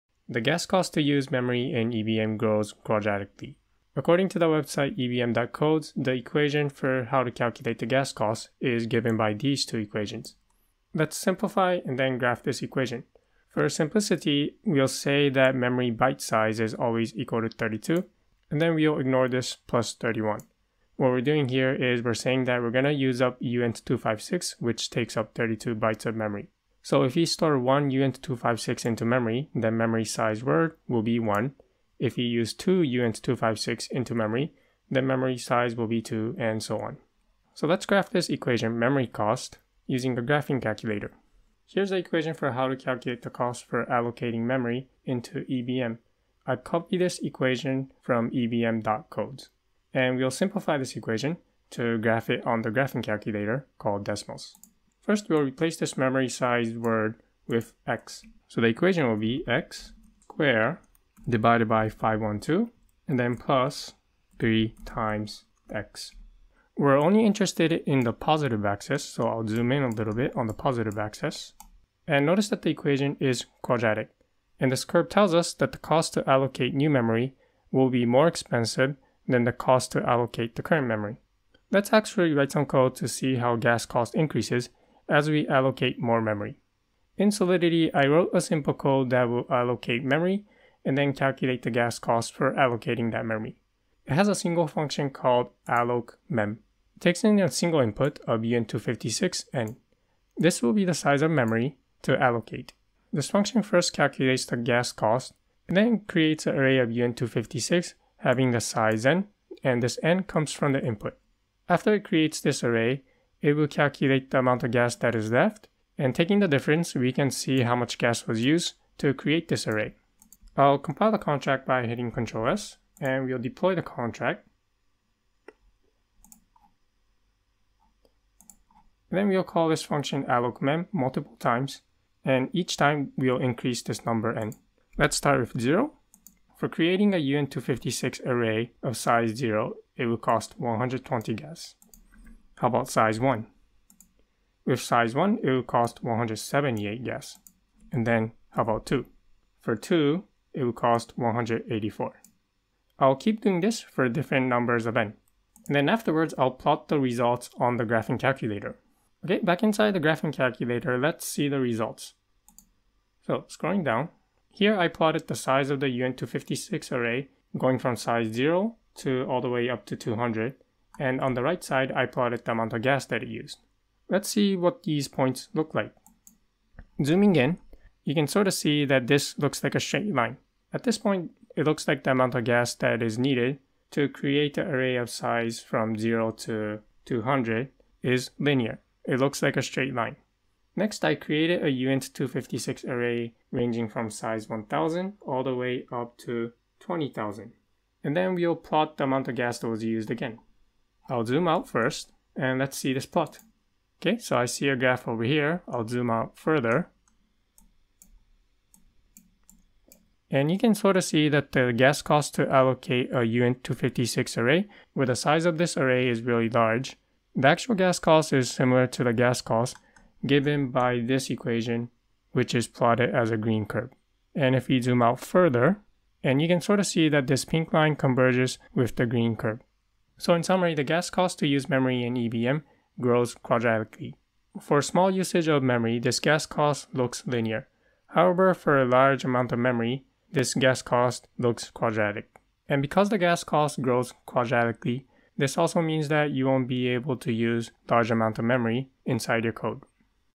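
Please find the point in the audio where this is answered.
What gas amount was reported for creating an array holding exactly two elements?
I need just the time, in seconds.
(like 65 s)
151 s.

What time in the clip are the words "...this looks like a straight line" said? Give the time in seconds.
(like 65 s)
179 s.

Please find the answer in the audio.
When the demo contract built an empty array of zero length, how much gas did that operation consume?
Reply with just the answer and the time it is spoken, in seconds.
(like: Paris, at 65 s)
120, at 140 s.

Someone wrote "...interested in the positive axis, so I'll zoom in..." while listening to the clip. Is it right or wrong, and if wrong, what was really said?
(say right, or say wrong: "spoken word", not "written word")
right.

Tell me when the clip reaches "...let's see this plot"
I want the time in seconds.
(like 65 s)
202 s.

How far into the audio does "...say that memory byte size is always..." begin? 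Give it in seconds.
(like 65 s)
14 s.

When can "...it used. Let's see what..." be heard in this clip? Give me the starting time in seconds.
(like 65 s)
173 s.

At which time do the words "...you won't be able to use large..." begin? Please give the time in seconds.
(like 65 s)
246 s.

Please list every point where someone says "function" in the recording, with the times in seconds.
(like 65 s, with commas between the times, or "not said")
94 s, 103 s, 129 s.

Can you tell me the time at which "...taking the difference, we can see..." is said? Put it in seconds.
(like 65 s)
116 s.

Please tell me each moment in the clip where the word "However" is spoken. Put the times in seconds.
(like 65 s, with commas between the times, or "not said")
238 s.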